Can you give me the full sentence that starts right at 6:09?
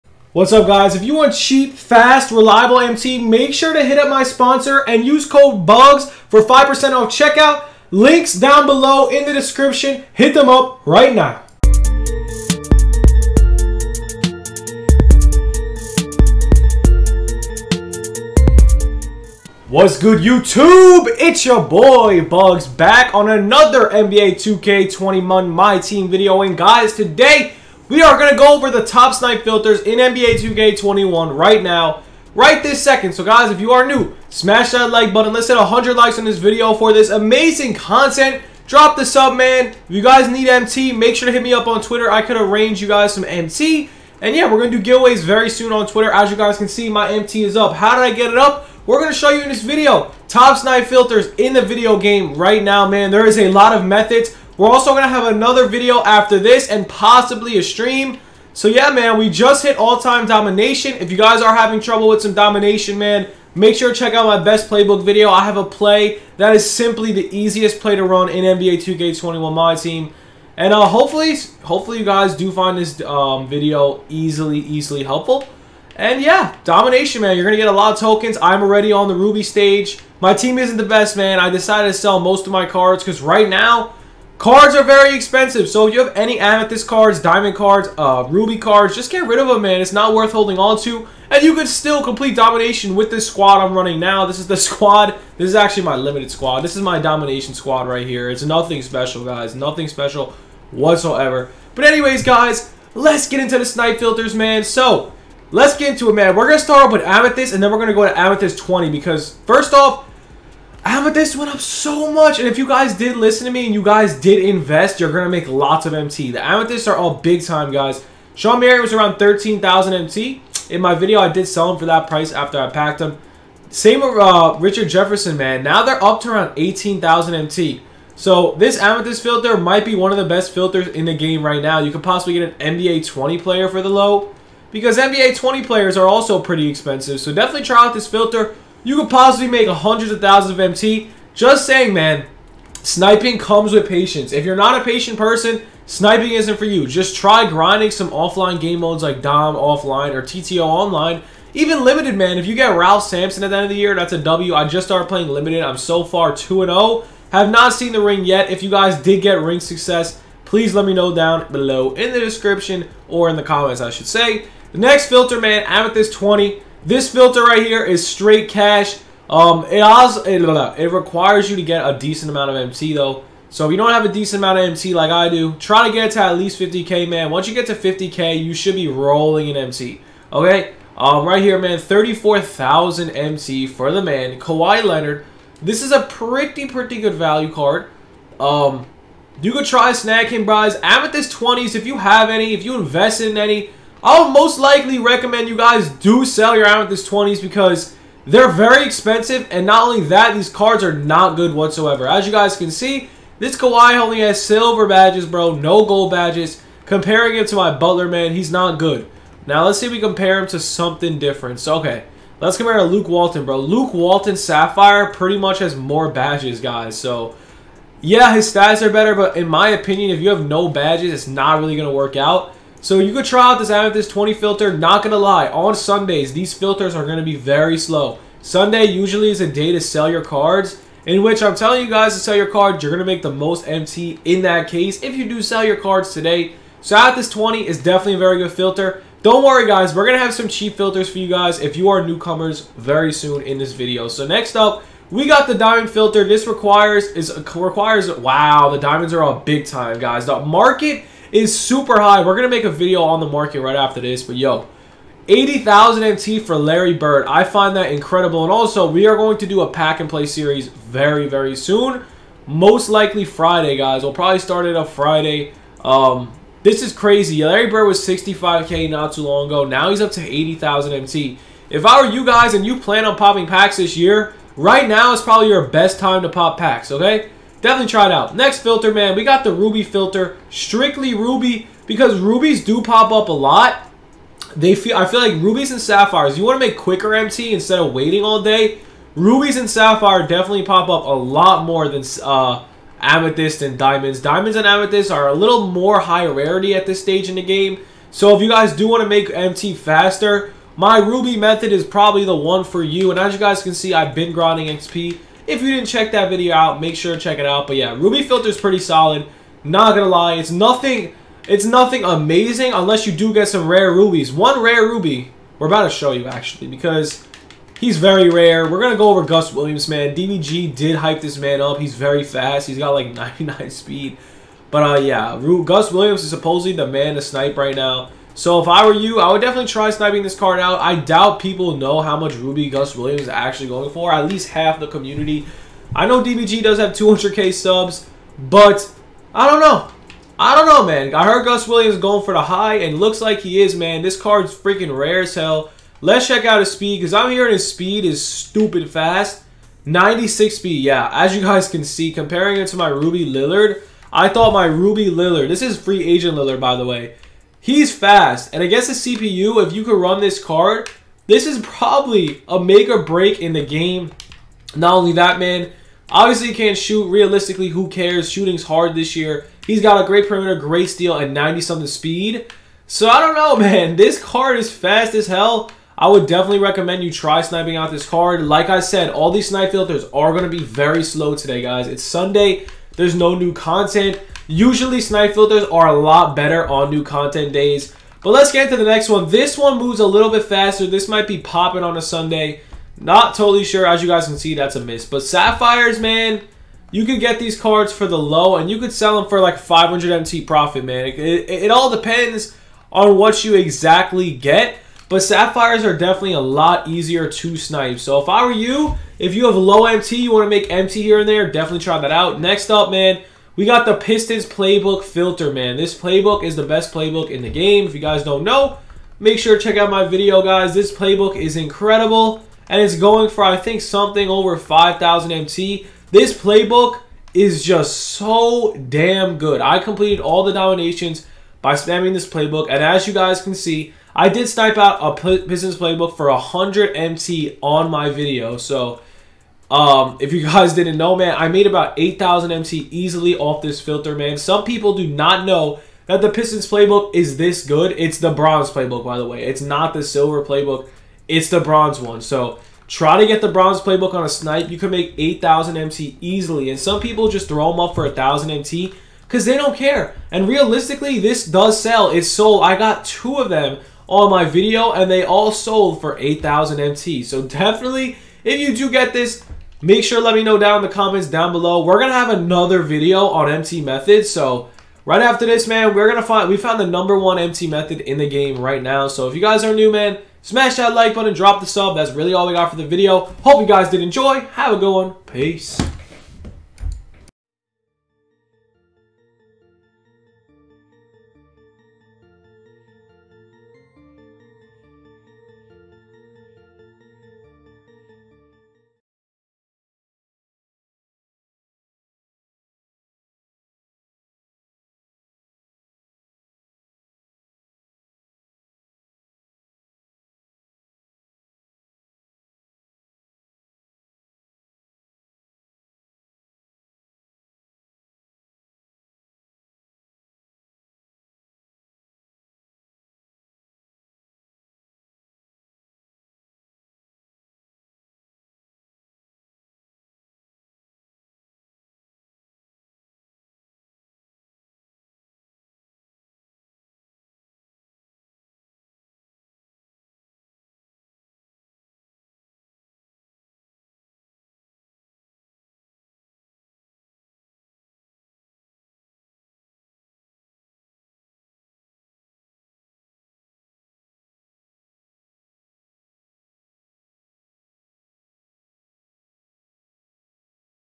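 He's got a great perimeter, great steal, and 90-something speed.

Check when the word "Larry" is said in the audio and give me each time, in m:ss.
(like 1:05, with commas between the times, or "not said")
4:16, 4:27.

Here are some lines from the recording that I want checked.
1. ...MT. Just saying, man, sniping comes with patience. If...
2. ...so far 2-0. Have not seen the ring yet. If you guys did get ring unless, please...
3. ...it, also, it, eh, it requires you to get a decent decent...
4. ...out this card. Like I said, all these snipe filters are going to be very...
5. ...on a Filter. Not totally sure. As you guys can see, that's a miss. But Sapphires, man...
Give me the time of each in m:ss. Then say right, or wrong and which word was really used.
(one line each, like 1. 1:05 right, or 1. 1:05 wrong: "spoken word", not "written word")
1. 2:20 right
2. 2:35 wrong: "success", not "unless"
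3. 2:49 wrong: "amount", not "decent"
4. 6:17 right
5. 6:31 wrong: "Sunday", not "Filter".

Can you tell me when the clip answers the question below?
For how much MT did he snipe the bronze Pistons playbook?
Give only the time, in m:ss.
7:16.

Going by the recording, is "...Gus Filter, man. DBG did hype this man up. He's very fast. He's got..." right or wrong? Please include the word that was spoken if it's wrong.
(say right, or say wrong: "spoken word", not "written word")
wrong: "Williams", not "Filter".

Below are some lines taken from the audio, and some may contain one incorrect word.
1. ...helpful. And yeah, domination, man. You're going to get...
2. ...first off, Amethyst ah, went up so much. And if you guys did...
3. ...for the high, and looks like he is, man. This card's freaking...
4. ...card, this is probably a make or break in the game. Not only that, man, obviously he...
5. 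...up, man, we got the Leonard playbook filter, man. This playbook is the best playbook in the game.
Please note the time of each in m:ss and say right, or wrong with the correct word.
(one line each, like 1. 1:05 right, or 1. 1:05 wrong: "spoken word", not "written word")
1. 1:15 right
2. 1:49 right
3. 5:42 right
4. 6:00 right
5. 6:52 wrong: "Pistons", not "Leonard".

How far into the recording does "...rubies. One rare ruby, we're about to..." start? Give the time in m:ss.
5:13.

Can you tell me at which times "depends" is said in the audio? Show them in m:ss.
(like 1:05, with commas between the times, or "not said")
6:41.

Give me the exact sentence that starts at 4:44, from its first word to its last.
They feel I feel like rubies and sapphires, you want to make quicker MT instead of waiting all day.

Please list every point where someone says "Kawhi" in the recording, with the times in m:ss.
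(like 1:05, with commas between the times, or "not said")
3:04, 3:23.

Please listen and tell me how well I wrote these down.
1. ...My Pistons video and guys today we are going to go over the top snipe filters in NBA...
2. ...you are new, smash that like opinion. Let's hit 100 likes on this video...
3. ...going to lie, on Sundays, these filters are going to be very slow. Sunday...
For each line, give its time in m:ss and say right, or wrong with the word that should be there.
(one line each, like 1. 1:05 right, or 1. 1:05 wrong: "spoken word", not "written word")
1. 0:25 wrong: "Team", not "Pistons"
2. 0:33 wrong: "button", not "opinion"
3. 3:45 right.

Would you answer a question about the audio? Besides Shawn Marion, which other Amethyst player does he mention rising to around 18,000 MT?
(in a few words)
Richard Jefferson.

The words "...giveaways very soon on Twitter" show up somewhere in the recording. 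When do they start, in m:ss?
0:44.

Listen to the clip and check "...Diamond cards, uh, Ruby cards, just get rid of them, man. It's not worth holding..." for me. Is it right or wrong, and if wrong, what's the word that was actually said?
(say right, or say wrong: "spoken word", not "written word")
right.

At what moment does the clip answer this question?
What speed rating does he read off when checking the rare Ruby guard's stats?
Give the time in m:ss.
5:49.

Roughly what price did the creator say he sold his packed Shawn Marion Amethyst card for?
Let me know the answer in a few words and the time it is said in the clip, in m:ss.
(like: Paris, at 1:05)
13,000 MT, at 1:59.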